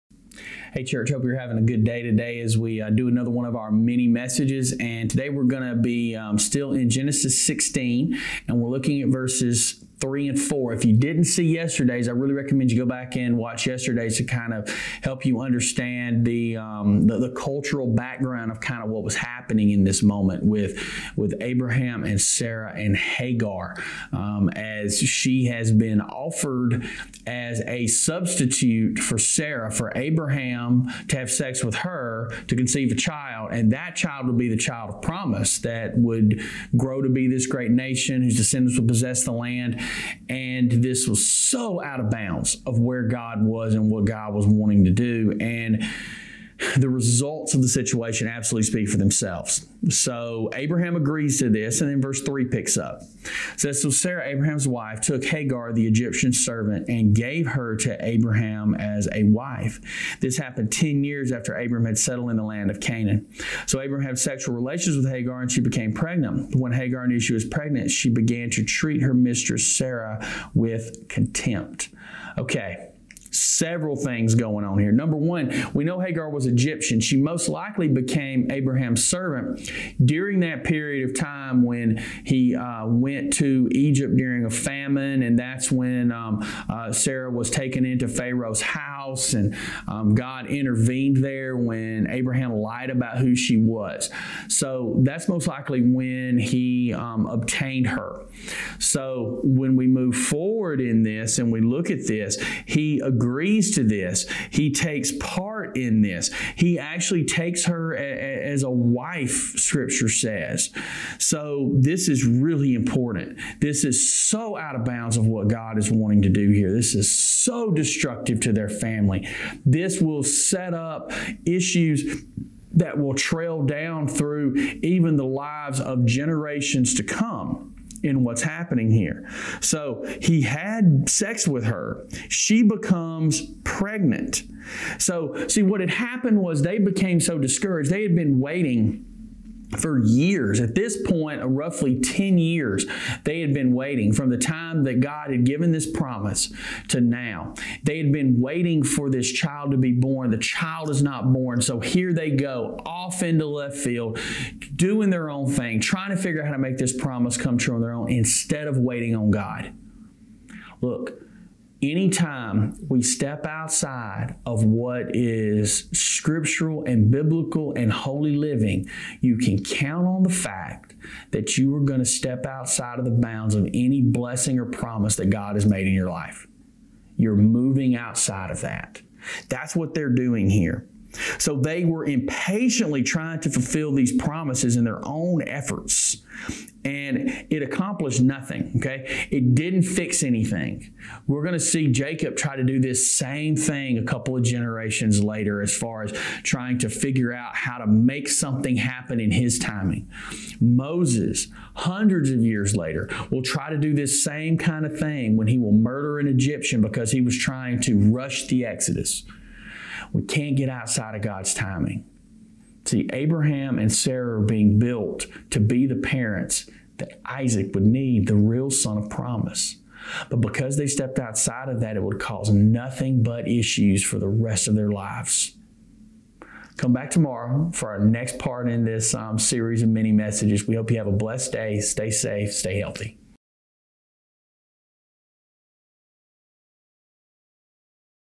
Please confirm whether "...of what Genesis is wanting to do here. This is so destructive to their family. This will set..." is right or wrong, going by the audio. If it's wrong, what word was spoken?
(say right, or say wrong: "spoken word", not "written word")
wrong: "God", not "Genesis".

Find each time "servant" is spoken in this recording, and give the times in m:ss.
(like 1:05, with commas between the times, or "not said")
0:56, 1:19.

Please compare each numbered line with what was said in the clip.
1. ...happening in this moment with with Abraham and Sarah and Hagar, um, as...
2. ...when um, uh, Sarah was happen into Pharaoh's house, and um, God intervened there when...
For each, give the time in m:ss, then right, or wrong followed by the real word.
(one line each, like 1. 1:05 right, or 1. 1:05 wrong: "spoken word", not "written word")
1. 0:19 right
2. 1:25 wrong: "taken", not "happen".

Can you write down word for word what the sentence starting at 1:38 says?
So when we move forward in this and we look at this, he agreed agrees to this.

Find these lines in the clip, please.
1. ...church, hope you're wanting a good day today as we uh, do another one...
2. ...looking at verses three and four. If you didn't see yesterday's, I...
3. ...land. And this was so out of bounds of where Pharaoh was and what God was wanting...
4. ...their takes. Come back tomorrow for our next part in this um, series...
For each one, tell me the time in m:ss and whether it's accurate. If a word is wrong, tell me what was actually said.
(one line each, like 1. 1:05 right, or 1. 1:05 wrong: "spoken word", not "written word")
1. 0:00 wrong: "having", not "wanting"
2. 0:08 right
3. 0:39 wrong: "God", not "Pharaoh"
4. 3:44 wrong: "lives", not "takes".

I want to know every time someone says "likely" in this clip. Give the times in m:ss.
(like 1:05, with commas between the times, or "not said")
1:17, 1:35.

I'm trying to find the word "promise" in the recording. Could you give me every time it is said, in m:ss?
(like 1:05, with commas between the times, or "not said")
0:35, 2:25, 2:36, 2:54, 3:04, 3:39.